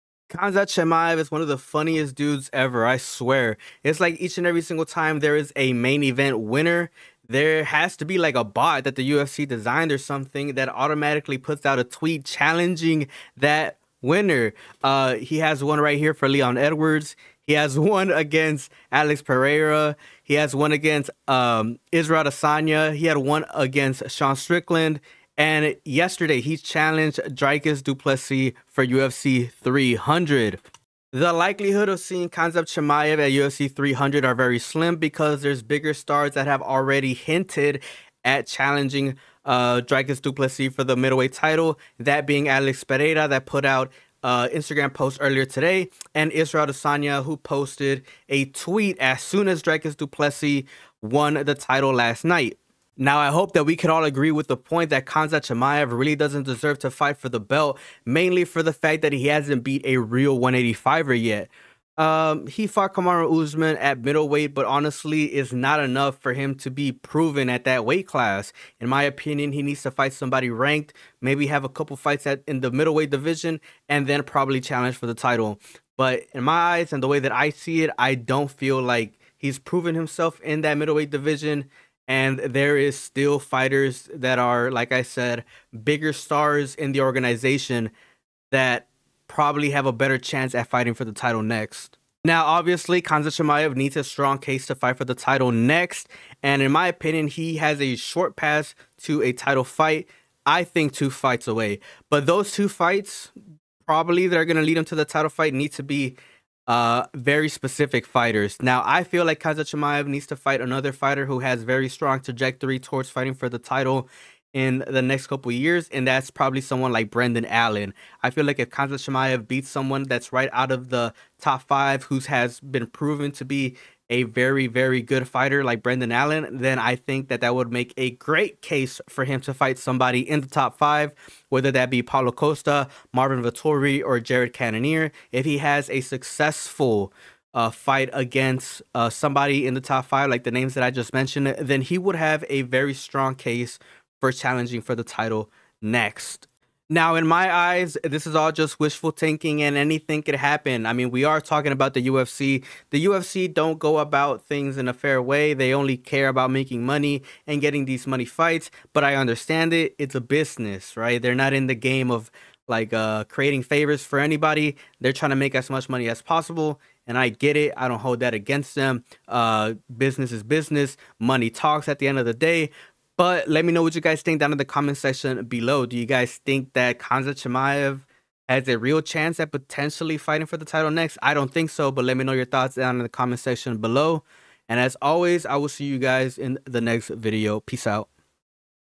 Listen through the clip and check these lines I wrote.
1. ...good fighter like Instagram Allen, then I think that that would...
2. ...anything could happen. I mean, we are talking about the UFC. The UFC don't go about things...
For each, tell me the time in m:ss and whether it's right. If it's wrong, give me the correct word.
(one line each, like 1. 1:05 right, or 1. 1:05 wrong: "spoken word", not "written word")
1. 2:05 wrong: "Brendan", not "Instagram"
2. 2:29 right.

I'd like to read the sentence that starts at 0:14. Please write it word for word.
Uh, he has one right here for Leon Edwards.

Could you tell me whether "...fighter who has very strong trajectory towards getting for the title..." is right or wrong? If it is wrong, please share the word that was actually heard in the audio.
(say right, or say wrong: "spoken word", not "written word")
wrong: "fighting", not "getting".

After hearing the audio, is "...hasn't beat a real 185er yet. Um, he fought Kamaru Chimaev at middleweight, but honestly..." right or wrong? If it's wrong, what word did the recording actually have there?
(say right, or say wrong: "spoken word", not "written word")
wrong: "Usman", not "Chimaev".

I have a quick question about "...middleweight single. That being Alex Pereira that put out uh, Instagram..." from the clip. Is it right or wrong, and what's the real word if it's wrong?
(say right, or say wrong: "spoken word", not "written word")
wrong: "title", not "single".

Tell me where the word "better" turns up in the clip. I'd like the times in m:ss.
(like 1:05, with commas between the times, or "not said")
1:29.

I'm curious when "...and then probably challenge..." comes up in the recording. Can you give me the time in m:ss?
1:13.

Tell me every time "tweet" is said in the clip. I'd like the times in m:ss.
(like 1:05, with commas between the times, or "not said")
0:11, 0:48.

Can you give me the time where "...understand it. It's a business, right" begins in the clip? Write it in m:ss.
2:39.